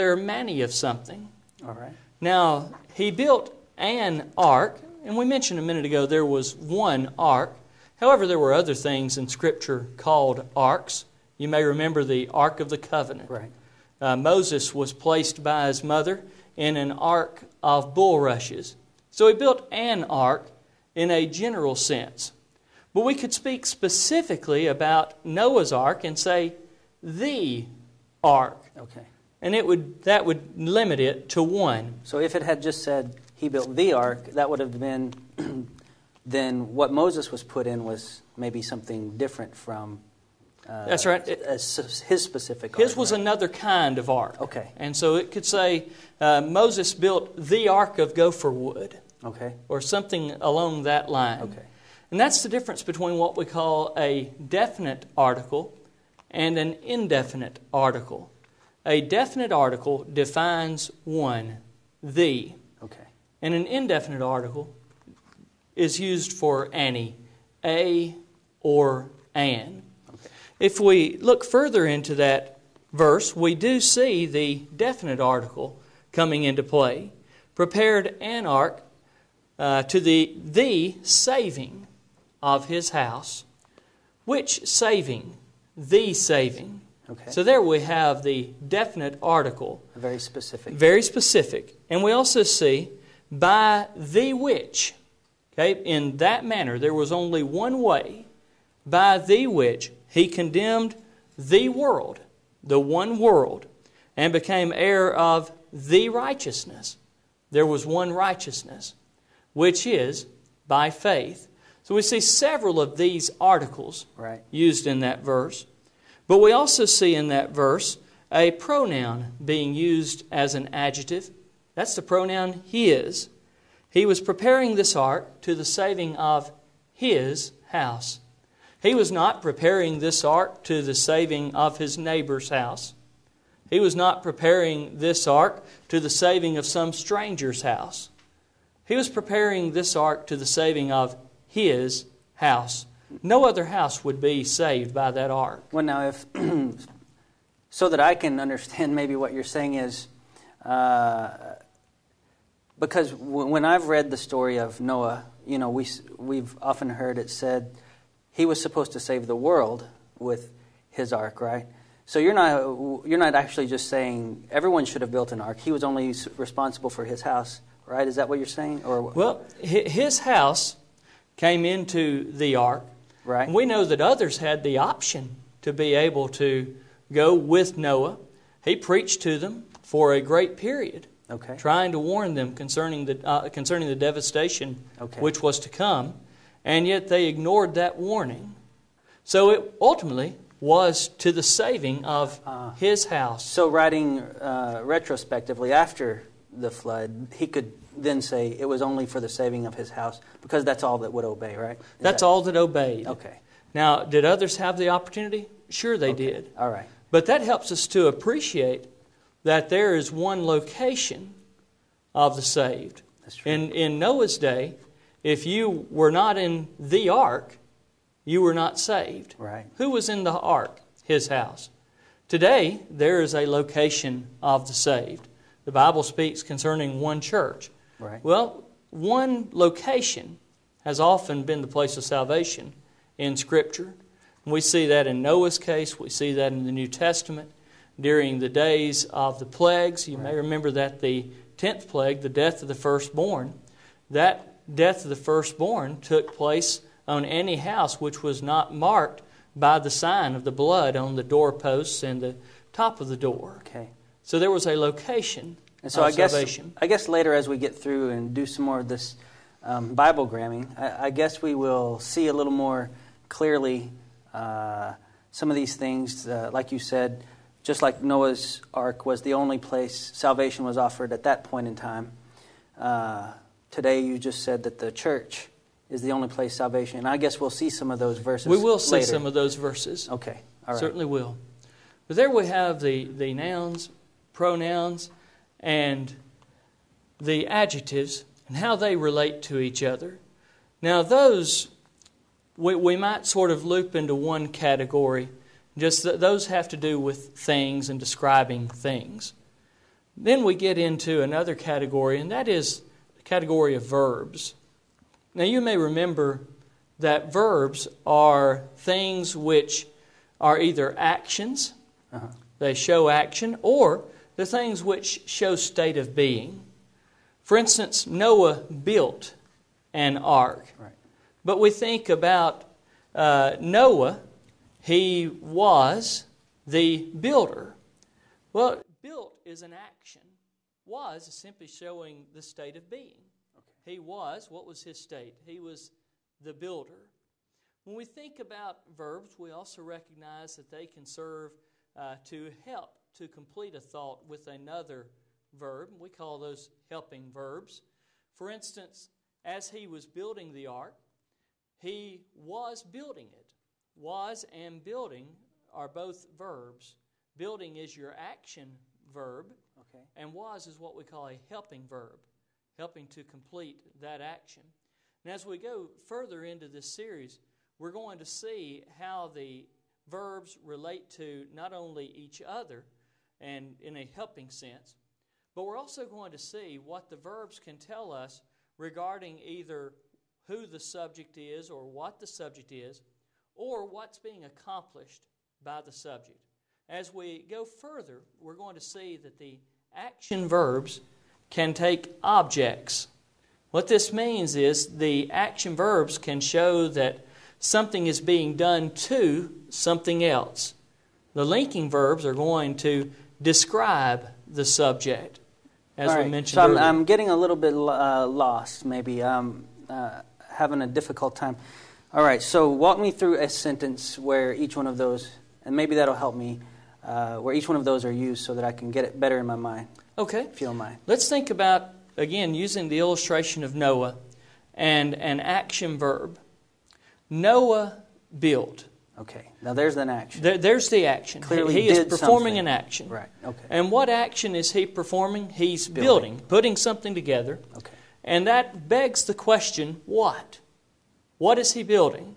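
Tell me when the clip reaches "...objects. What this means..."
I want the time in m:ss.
6:32.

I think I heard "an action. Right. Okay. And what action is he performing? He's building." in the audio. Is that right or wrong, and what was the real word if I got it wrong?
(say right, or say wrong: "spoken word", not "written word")
right.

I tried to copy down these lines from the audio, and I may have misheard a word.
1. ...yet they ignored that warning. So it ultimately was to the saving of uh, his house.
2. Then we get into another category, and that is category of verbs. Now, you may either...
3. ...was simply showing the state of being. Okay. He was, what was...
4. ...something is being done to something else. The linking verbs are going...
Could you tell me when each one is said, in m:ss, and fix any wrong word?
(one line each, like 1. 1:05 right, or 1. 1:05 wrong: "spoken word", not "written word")
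1. 3:06 right
2. 5:00 wrong: "remember", not "either"
3. 5:30 right
4. 6:37 right.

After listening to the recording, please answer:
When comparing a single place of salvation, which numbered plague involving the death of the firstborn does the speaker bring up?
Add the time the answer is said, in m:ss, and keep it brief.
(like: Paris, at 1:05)
10th plague, at 4:01.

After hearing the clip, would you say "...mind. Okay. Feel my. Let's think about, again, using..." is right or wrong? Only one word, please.
right.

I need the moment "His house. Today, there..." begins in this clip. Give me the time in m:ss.
3:41.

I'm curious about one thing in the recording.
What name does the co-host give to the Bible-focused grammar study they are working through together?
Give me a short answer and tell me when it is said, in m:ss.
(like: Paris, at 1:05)
Biblegramming, at 4:19.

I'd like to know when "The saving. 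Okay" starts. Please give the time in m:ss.
1:25.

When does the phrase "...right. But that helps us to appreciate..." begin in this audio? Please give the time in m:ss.
3:26.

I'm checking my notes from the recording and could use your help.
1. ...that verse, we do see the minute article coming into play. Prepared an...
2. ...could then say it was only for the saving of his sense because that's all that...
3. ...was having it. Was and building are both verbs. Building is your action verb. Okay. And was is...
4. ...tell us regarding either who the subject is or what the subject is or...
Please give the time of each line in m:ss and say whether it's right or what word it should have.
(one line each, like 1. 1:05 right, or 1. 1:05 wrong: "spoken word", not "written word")
1. 1:12 wrong: "definite", not "minute"
2. 3:17 wrong: "house", not "sense"
3. 5:52 wrong: "building", not "having"
4. 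6:17 right.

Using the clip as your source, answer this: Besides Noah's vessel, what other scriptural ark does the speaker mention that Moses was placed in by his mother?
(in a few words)
an ark of bulrushes.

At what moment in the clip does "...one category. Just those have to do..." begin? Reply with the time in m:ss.
4:54.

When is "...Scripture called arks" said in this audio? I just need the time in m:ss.
0:09.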